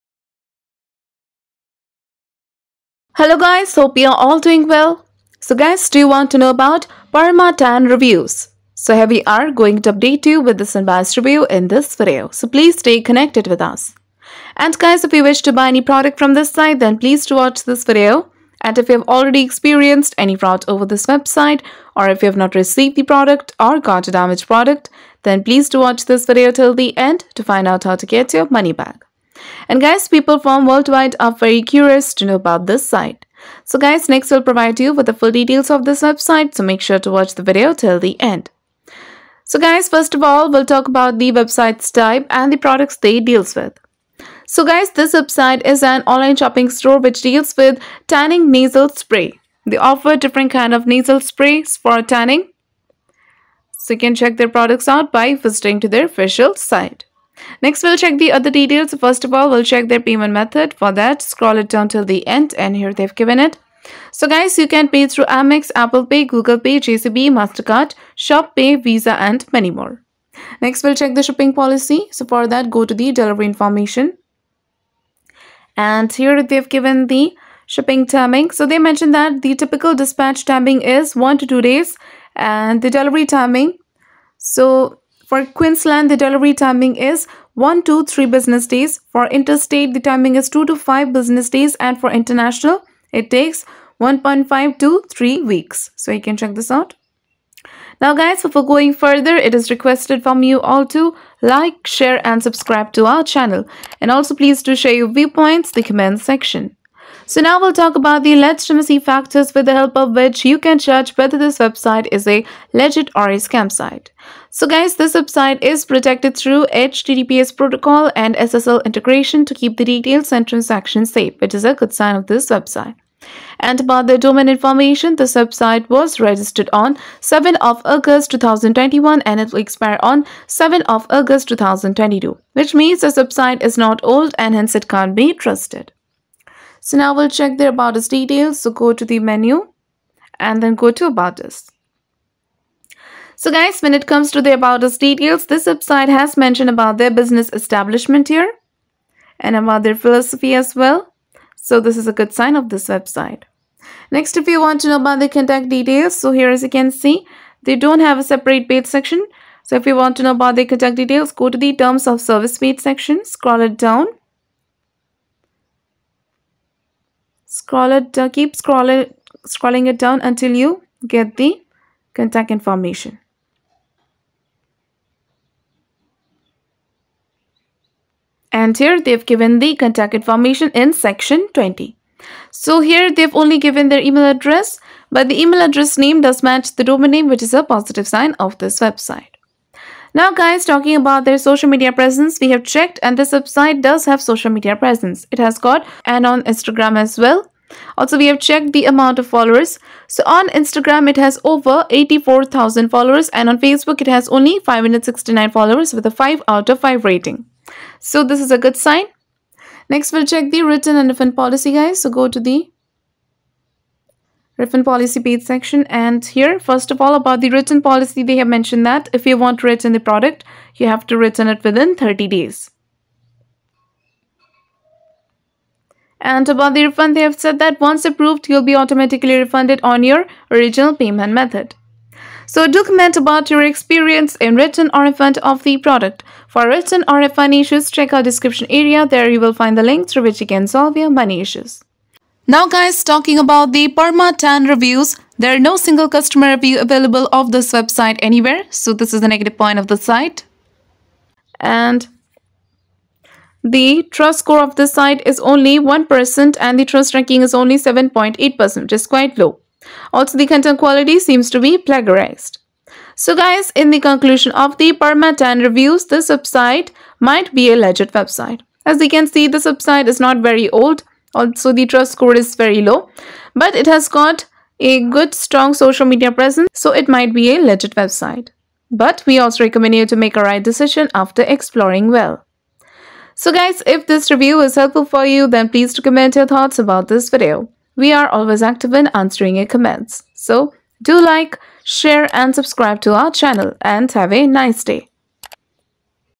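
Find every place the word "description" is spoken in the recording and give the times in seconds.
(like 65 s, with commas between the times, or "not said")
238 s.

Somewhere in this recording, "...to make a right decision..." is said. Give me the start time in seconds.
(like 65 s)
280 s.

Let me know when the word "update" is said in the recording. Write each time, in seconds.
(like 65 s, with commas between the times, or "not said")
9 s.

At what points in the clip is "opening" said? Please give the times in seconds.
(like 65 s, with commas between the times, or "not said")
not said.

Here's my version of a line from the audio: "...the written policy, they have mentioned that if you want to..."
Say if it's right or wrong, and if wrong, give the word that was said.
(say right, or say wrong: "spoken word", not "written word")
right.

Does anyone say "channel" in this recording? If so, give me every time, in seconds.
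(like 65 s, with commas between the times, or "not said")
103 s, 293 s.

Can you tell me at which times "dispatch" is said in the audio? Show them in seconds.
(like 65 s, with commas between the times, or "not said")
79 s.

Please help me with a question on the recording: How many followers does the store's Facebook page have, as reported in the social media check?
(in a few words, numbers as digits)
569.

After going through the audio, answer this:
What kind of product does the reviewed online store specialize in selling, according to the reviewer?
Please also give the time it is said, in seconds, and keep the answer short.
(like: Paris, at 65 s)
Tanning nasal spray, at 48 s.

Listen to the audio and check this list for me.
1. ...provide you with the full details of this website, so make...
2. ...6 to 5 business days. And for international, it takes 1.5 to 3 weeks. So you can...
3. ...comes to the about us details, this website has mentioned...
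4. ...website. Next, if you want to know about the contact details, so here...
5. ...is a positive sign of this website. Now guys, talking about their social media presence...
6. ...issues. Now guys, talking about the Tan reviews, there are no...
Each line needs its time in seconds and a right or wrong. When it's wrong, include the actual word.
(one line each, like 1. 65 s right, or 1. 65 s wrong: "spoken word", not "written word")
1. 34 s right
2. 90 s wrong: "2", not "6"
3. 144 s right
4. 152 s right
5. 187 s right
6. 241 s right.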